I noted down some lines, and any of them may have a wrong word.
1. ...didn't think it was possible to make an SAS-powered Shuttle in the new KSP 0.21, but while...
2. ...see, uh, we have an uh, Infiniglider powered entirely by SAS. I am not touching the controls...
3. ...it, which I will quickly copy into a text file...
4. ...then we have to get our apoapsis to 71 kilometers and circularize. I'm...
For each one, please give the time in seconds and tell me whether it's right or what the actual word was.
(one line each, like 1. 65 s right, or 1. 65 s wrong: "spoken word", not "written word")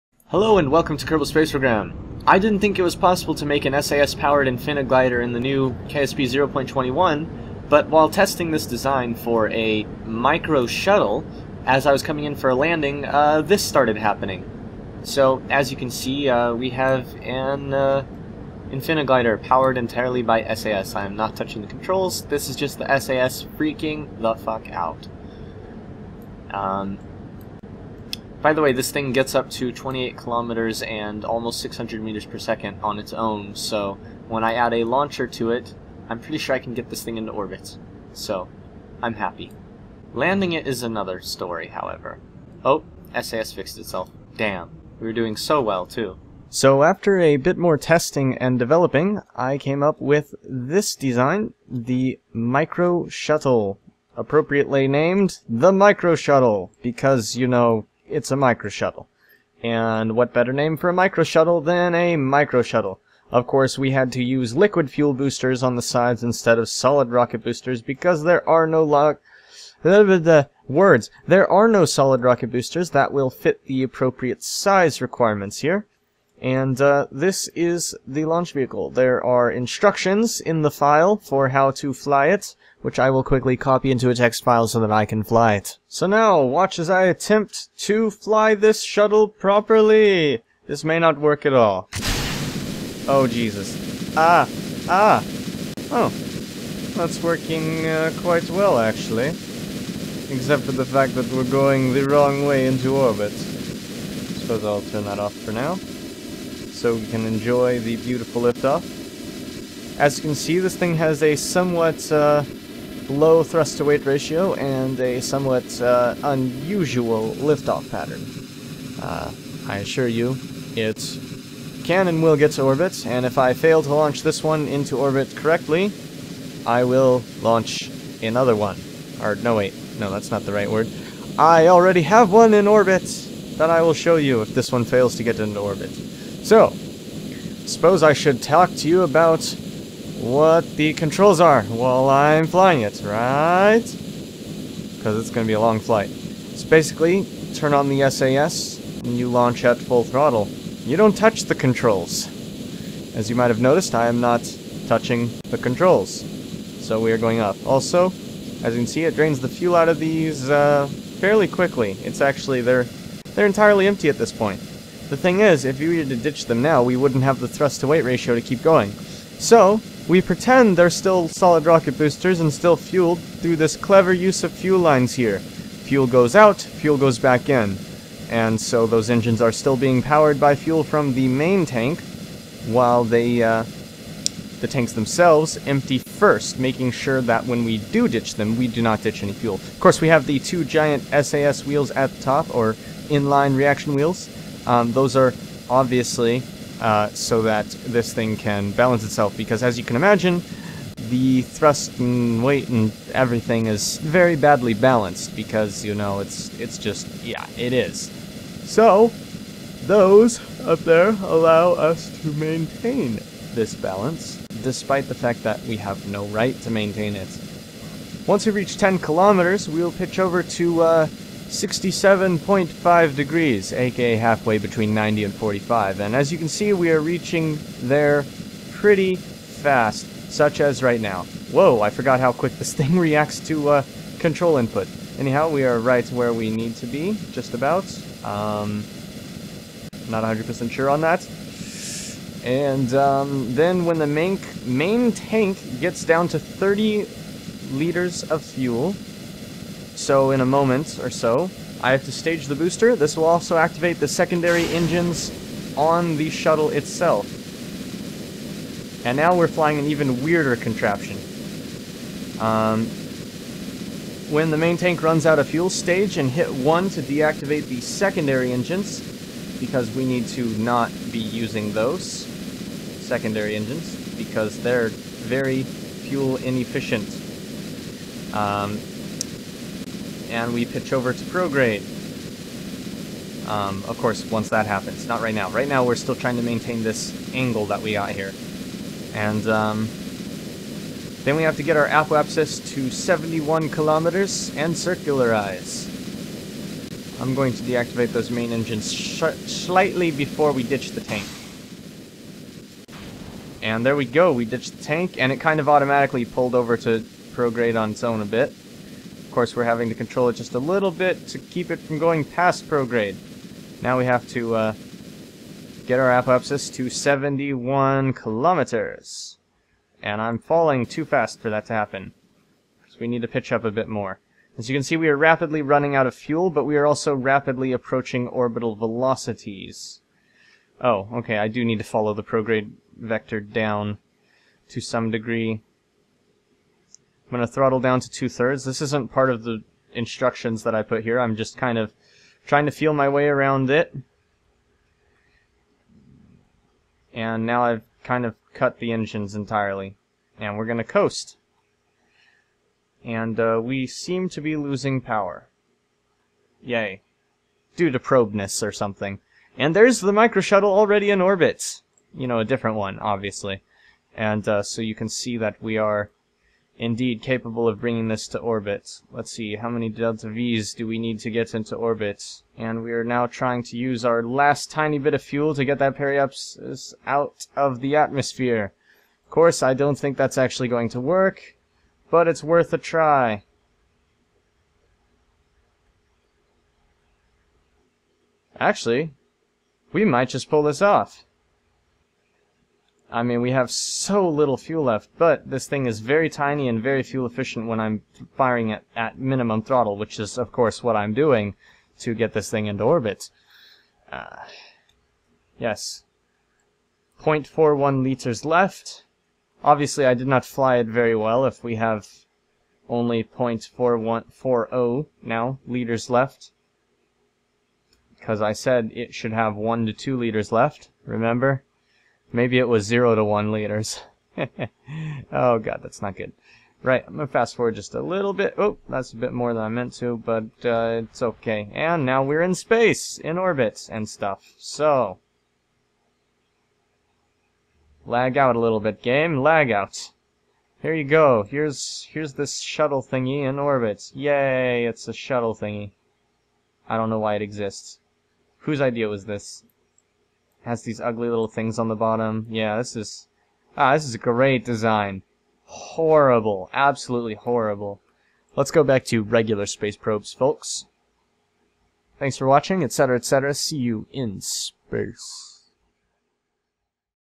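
1. 2 s wrong: "Infiniglider", not "Shuttle"
2. 15 s right
3. 82 s right
4. 291 s right.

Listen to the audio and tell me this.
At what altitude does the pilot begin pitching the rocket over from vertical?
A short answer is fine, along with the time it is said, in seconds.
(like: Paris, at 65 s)
10 kilometers, at 218 s.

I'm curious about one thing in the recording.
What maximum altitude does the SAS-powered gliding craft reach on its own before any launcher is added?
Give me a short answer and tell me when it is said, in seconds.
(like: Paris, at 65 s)
28 kilometers, at 29 s.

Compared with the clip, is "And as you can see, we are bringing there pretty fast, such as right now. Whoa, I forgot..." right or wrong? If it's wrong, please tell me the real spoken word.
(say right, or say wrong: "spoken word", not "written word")
wrong: "reaching", not "bringing".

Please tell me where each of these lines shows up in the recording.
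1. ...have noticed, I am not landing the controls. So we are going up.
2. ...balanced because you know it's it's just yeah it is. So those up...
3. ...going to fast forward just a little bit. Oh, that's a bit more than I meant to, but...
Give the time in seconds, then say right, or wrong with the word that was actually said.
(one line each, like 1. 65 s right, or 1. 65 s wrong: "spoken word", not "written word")
1. 153 s wrong: "touching", not "landing"
2. 204 s right
3. 427 s right.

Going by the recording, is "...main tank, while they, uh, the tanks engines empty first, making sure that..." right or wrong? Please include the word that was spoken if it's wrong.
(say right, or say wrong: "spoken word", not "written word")
wrong: "themselves", not "engines".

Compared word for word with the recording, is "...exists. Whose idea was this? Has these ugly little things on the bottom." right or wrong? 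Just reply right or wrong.
right.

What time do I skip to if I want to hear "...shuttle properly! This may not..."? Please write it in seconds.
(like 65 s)
88 s.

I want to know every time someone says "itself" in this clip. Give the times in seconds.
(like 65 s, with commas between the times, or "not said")
43 s, 199 s, 256 s.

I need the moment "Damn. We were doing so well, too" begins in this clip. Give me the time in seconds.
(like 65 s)
44 s.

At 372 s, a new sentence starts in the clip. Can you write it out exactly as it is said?
And we are now trying to use our last tiny bit of fuel to get that periapsis out of the atmosphere.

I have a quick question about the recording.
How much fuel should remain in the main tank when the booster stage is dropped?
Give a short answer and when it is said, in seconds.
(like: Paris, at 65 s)
30 liters, at 246 s.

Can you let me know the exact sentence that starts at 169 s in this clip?
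So, we pretend they're still solid rocket boosters and still fueled through this clever use of fuel lines here.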